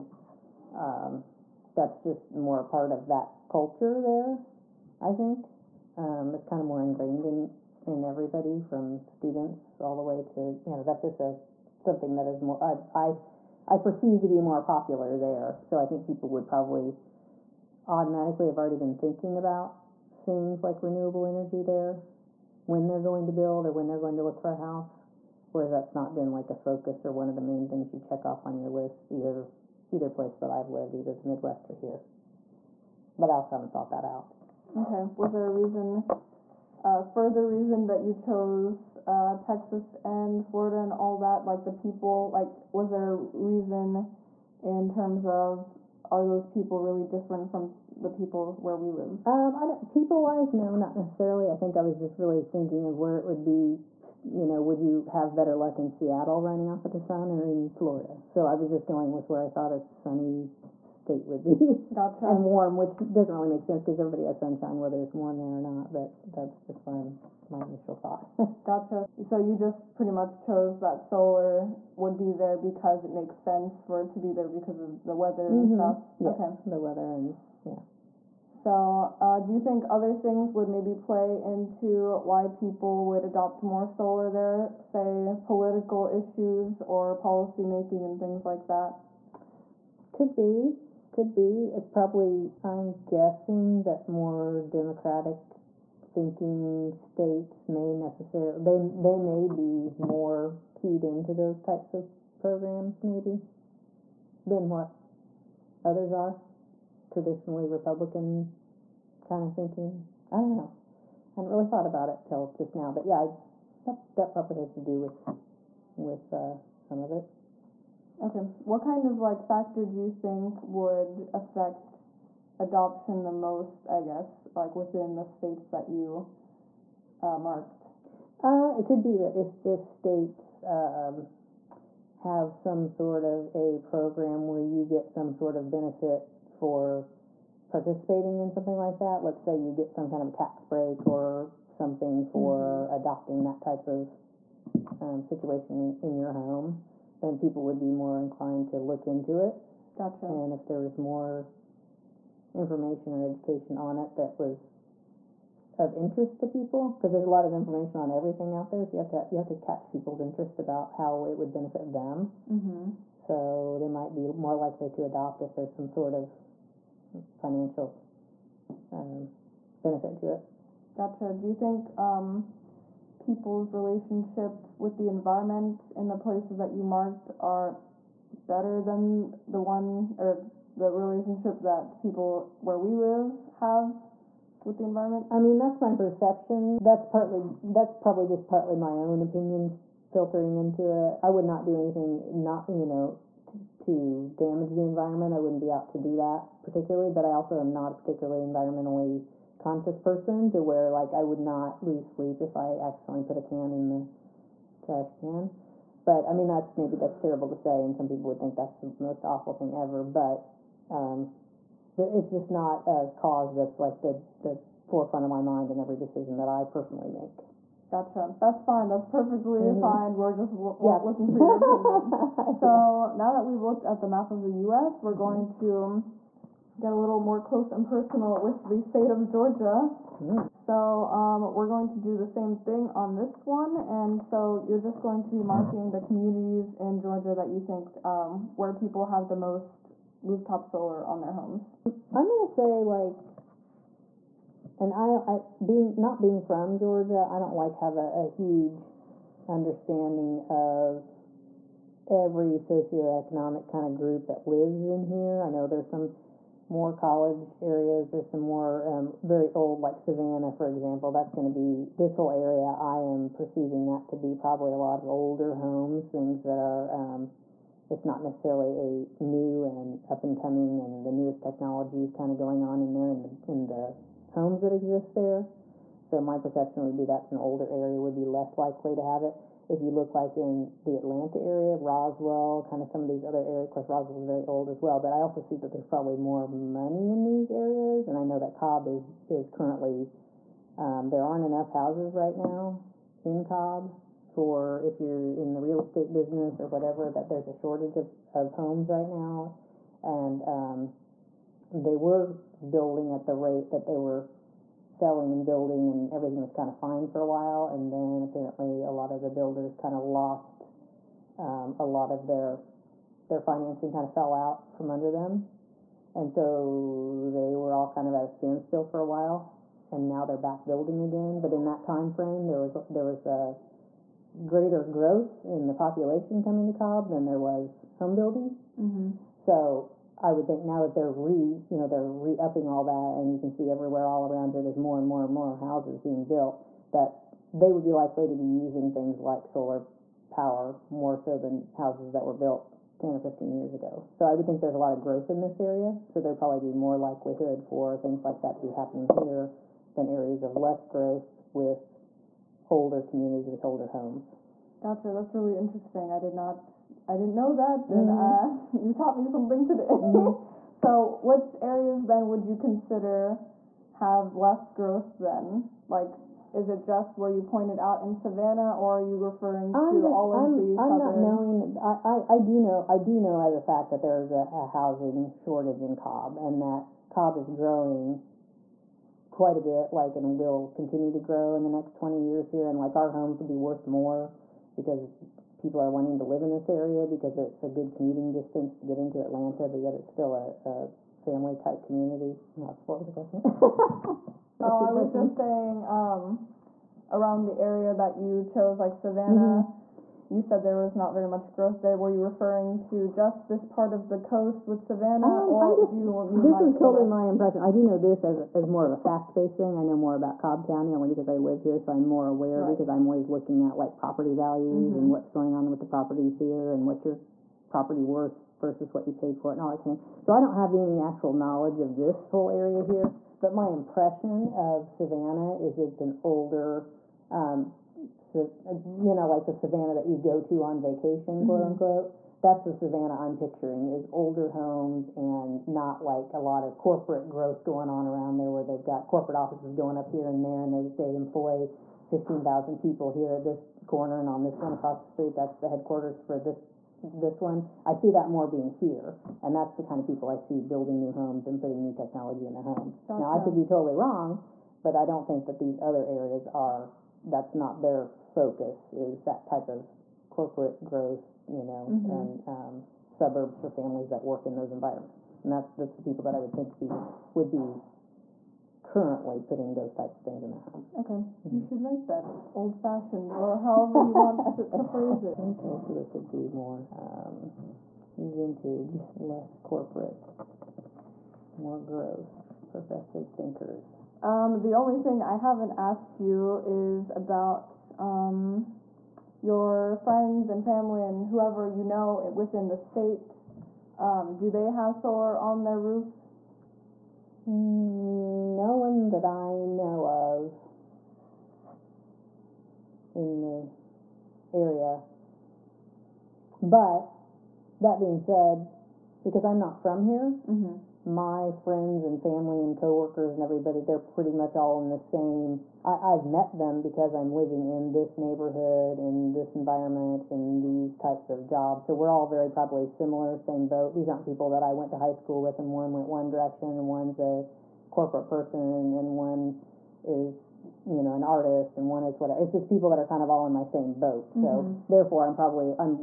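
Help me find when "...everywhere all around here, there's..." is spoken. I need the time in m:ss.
5:33.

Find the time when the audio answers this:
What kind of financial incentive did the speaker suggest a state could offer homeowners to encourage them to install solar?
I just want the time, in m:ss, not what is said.
2:20.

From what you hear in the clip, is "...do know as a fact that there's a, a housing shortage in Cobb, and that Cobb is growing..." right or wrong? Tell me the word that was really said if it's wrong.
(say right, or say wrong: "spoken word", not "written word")
right.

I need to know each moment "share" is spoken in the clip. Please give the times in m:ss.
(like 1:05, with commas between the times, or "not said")
not said.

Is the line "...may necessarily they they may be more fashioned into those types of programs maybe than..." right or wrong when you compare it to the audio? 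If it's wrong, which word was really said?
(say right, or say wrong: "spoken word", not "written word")
wrong: "keyed", not "fashioned".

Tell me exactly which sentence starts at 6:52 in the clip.
because I'm always looking at like property values mm-hmm.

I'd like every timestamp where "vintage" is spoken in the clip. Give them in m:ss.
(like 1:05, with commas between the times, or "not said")
7:58.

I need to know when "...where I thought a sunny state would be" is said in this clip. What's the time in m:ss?
0:59.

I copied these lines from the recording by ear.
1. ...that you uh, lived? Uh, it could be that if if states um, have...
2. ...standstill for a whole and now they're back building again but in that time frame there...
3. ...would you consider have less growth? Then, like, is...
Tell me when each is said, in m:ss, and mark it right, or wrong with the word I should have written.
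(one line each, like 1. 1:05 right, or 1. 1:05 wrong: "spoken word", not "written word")
1. 2:05 wrong: "marked", not "lived"
2. 5:18 wrong: "while", not "whole"
3. 6:02 right.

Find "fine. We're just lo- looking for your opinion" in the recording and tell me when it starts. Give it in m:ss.
3:39.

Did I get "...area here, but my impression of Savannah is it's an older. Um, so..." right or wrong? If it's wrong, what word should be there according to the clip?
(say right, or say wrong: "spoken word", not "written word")
right.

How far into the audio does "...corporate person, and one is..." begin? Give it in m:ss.
8:47.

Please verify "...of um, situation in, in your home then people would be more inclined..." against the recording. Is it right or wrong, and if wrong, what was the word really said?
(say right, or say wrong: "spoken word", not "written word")
right.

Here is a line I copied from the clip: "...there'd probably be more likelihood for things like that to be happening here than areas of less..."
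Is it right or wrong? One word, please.
right.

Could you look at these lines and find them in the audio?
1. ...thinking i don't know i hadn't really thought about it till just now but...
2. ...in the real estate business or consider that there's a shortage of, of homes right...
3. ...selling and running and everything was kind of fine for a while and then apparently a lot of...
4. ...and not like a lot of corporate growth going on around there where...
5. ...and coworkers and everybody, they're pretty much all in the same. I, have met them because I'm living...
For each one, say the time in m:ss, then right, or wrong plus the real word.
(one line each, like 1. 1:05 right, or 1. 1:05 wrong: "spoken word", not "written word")
1. 1:49 right
2. 4:55 wrong: "whatever", not "consider"
3. 5:04 wrong: "building", not "running"
4. 7:15 right
5. 8:32 right.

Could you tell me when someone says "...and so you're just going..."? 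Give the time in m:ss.
3:53.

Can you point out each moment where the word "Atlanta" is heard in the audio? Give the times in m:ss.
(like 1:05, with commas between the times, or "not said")
4:40, 6:29.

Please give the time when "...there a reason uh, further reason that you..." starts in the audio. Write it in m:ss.
0:35.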